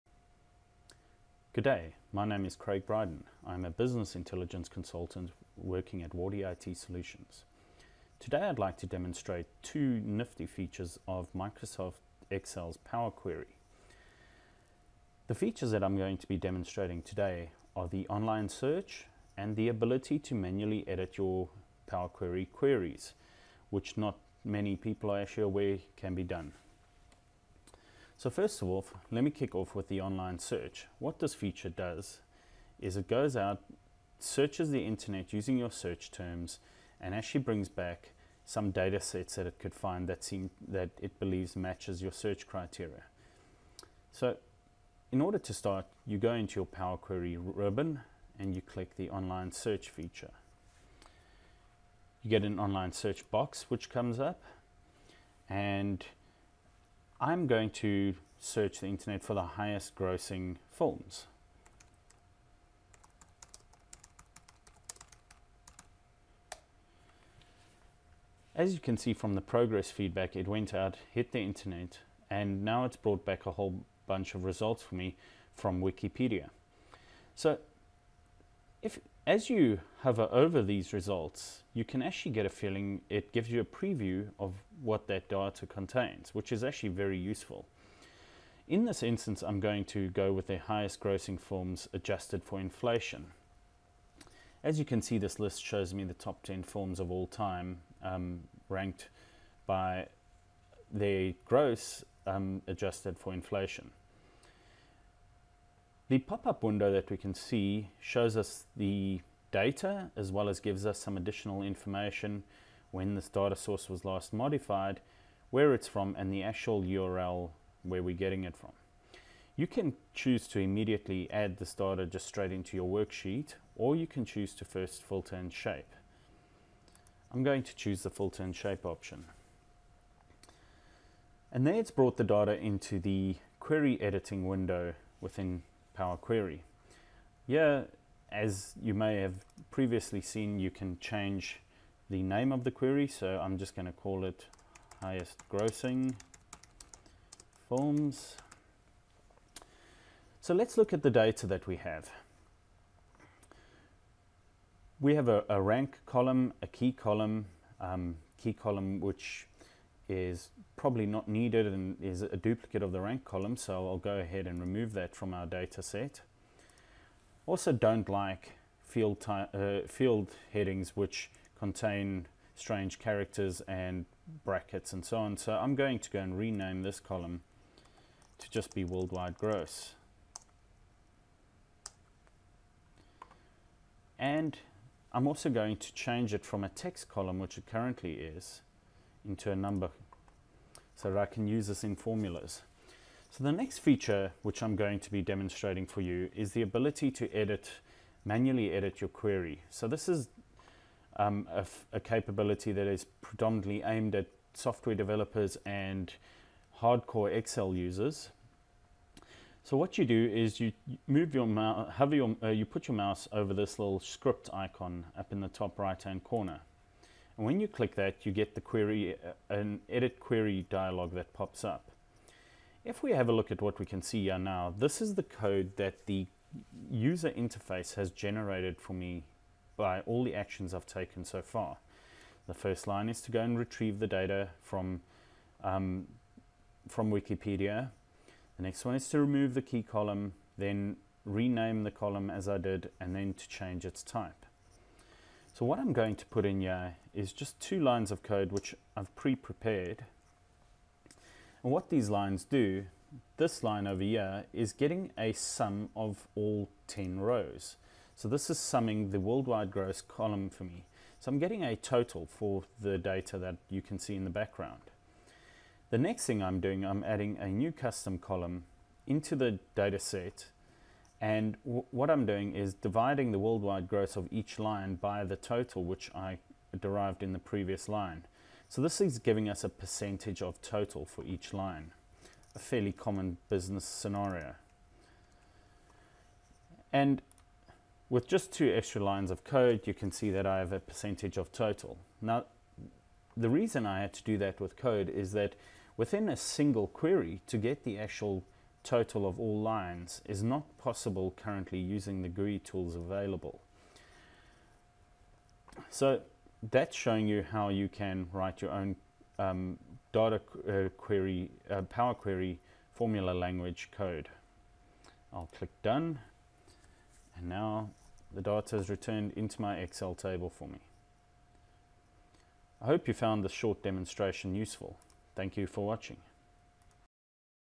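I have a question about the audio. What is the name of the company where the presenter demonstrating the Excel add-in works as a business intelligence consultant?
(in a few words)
Wardy IT Solutions.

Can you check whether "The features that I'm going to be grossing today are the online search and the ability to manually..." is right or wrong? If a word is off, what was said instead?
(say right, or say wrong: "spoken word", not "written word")
wrong: "demonstrating", not "grossing".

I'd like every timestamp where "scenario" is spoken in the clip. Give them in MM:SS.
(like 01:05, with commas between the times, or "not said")
04:43.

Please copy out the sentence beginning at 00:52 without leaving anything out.
You get an online search box which comes up and I'm going to search the internet for the highest grossing films.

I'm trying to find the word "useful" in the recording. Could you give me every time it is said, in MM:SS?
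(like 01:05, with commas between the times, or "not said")
01:27, 05:24.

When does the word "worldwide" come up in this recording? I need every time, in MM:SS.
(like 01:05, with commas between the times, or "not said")
02:58, 04:19, 04:33.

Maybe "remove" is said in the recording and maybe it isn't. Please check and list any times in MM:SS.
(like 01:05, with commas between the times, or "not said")
02:44, 03:59.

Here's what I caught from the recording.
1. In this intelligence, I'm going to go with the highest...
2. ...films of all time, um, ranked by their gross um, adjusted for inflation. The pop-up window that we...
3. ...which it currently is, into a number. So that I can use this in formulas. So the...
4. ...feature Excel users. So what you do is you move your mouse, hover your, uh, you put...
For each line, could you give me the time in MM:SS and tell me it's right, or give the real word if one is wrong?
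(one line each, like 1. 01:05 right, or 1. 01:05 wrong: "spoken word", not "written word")
1. 01:28 wrong: "instance", not "intelligence"
2. 01:36 right
3. 03:07 right
4. 03:26 wrong: "hardcore", not "feature".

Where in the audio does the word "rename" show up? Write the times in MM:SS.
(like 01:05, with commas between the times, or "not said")
02:56, 04:01.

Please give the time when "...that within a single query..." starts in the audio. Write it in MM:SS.
04:55.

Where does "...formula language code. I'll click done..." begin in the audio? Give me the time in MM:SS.
05:12.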